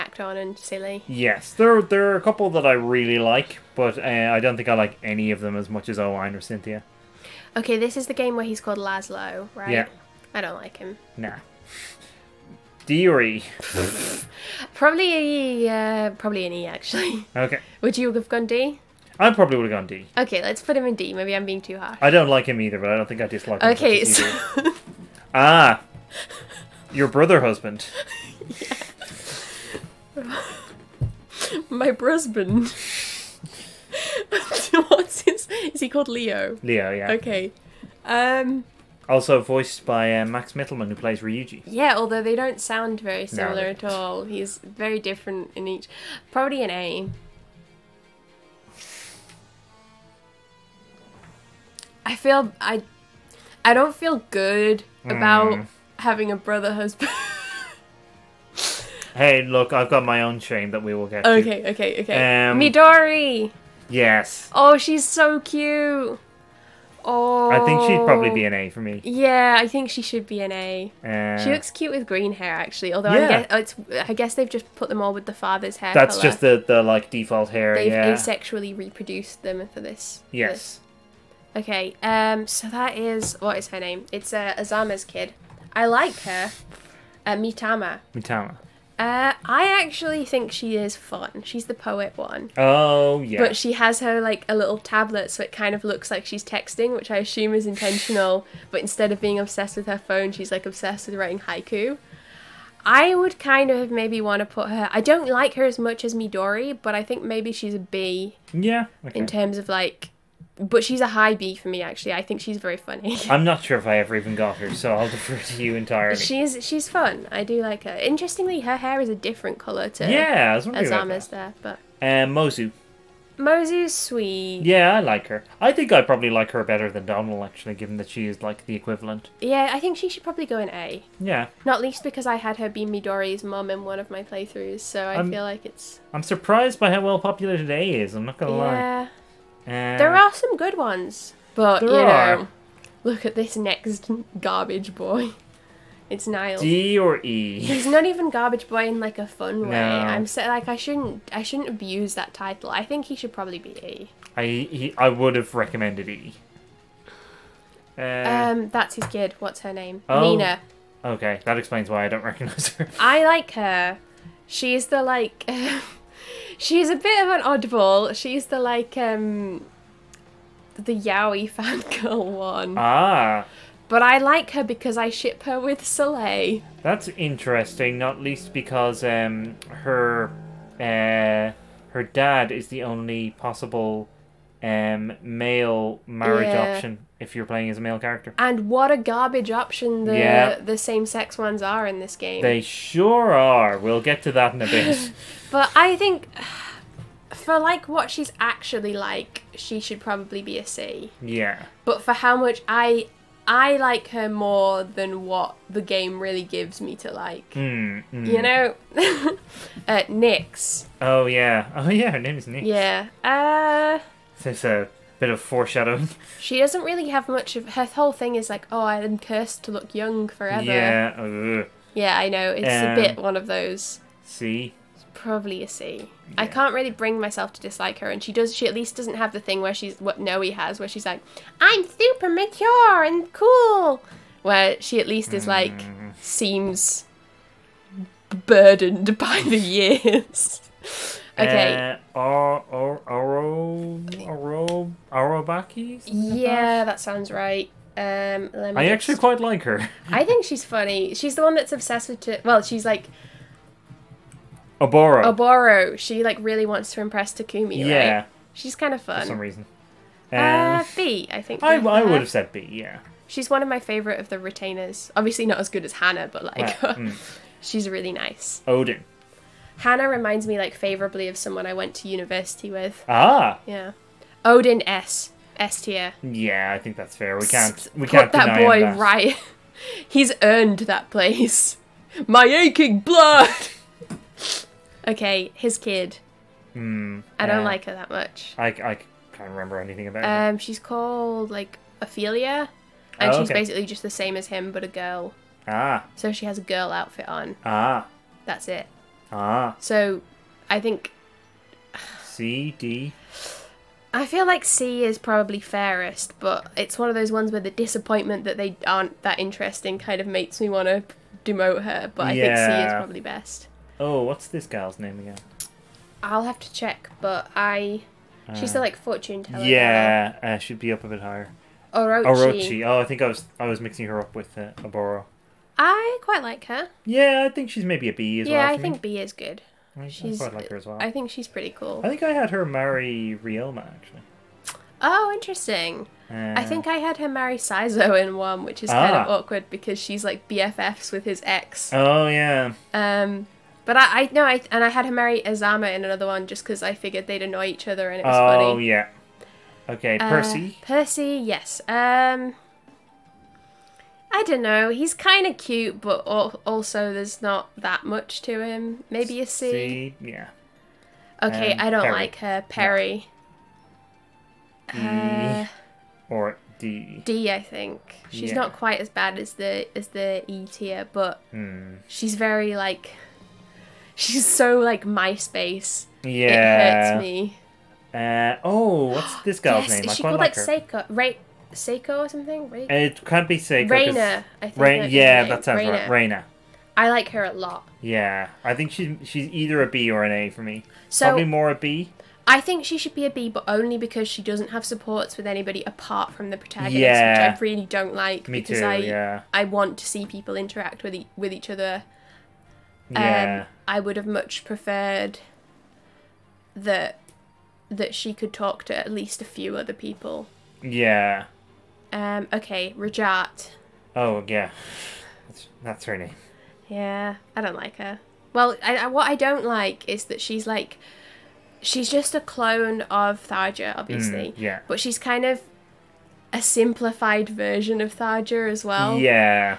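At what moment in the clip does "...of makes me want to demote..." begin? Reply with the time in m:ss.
5:10.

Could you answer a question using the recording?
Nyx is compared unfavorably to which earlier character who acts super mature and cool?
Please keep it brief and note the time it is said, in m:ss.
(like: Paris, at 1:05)
Nowi, at 3:50.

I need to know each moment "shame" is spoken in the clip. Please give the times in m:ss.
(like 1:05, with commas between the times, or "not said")
1:00.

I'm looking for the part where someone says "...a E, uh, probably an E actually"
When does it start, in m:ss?
0:15.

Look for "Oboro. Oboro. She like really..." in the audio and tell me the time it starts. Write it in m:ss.
4:14.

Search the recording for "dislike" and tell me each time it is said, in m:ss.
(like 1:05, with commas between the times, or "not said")
0:23, 3:47.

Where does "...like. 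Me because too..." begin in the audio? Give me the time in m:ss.
6:38.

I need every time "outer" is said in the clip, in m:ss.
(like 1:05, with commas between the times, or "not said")
not said.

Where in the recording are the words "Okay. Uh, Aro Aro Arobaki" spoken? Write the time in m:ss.
4:01.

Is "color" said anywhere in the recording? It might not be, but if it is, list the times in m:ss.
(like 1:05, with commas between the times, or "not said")
1:16, 1:59.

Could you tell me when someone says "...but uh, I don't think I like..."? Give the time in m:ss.
0:03.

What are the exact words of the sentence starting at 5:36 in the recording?
Uh, I think I had her marry Saizo in one, which is ah.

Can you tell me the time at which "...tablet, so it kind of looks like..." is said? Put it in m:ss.
1:34.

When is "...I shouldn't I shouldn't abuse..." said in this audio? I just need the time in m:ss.
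2:30.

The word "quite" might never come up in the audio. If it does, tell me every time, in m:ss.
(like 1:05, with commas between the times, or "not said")
4:09, 5:26, 5:30, 6:08.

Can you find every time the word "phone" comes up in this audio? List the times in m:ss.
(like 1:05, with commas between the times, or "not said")
1:39.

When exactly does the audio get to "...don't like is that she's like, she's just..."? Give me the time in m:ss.
6:59.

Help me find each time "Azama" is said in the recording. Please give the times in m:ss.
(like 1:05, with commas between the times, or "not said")
1:24, 2:00, 5:45.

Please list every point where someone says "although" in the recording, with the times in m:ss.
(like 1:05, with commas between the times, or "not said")
0:41, 1:12.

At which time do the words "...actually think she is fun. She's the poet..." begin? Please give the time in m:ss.
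1:29.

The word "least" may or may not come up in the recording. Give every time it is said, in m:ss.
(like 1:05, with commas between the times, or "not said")
2:11, 2:58, 3:48, 3:55, 6:49.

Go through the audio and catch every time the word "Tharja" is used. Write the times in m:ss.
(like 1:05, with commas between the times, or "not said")
7:03, 7:08.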